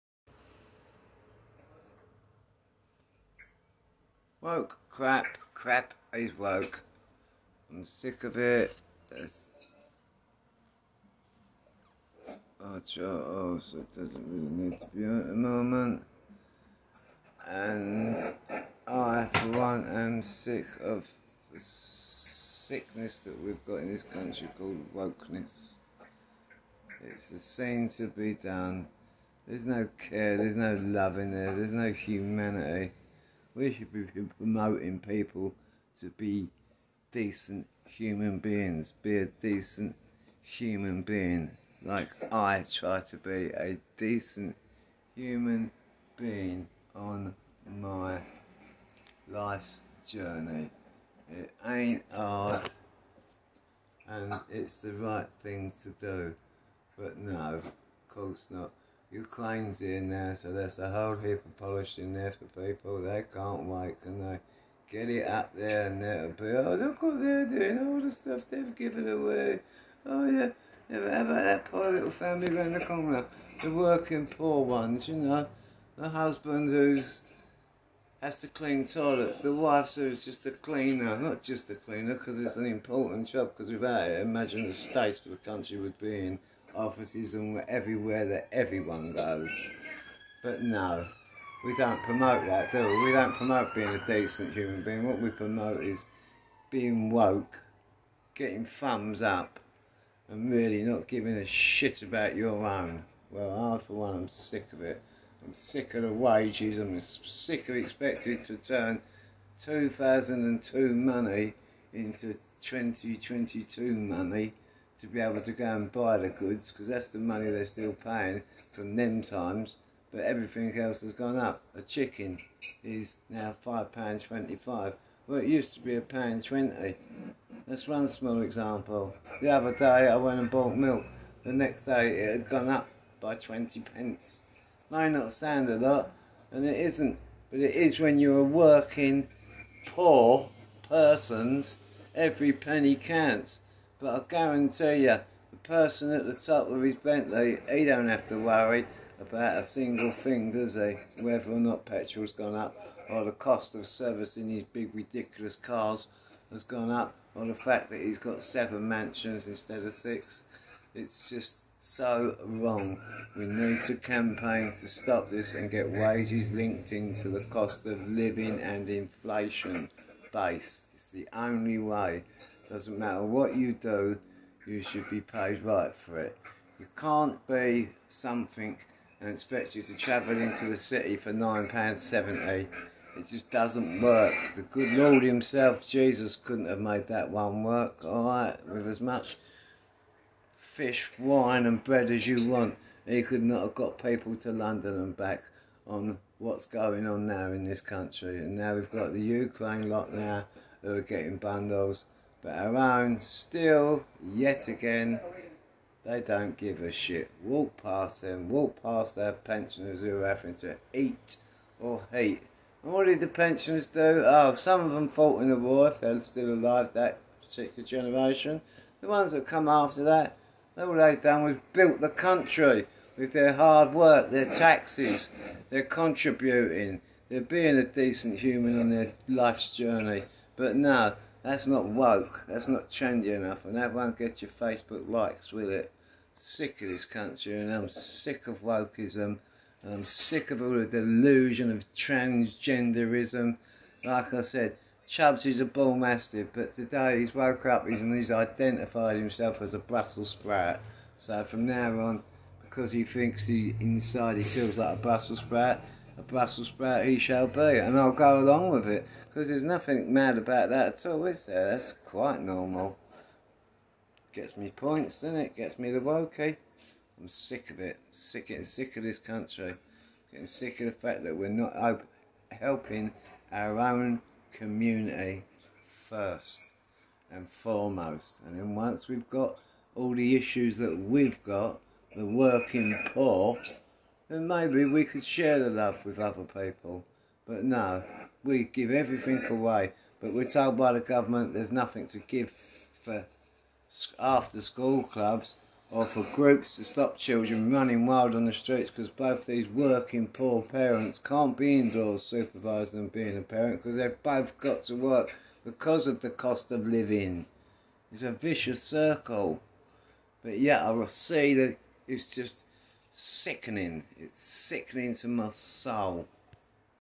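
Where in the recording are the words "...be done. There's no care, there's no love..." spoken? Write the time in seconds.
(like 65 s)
28 s.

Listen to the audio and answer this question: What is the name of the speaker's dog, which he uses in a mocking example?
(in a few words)
Chubbs.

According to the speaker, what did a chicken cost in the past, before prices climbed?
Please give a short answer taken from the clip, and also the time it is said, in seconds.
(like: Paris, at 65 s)
£1.20, at 125 s.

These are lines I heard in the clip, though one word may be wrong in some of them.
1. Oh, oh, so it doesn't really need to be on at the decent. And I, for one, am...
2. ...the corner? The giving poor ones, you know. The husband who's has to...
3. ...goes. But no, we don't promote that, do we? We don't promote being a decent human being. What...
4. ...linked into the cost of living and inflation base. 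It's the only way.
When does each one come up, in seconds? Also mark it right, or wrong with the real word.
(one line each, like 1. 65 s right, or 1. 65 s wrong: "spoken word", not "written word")
1. 12 s wrong: "moment", not "decent"
2. 72 s wrong: "working", not "giving"
3. 89 s right
4. 166 s right.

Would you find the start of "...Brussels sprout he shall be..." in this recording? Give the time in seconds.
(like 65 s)
256 s.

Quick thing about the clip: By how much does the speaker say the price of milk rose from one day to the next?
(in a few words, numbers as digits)
20p.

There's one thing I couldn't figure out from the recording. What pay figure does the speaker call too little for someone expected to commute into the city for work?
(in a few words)
£9.70.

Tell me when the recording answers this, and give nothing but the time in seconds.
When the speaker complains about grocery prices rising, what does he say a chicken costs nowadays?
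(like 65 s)
123 s.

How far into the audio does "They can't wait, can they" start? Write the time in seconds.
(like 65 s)
63 s.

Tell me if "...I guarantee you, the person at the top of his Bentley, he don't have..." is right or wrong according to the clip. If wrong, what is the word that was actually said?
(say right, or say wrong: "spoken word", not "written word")
right.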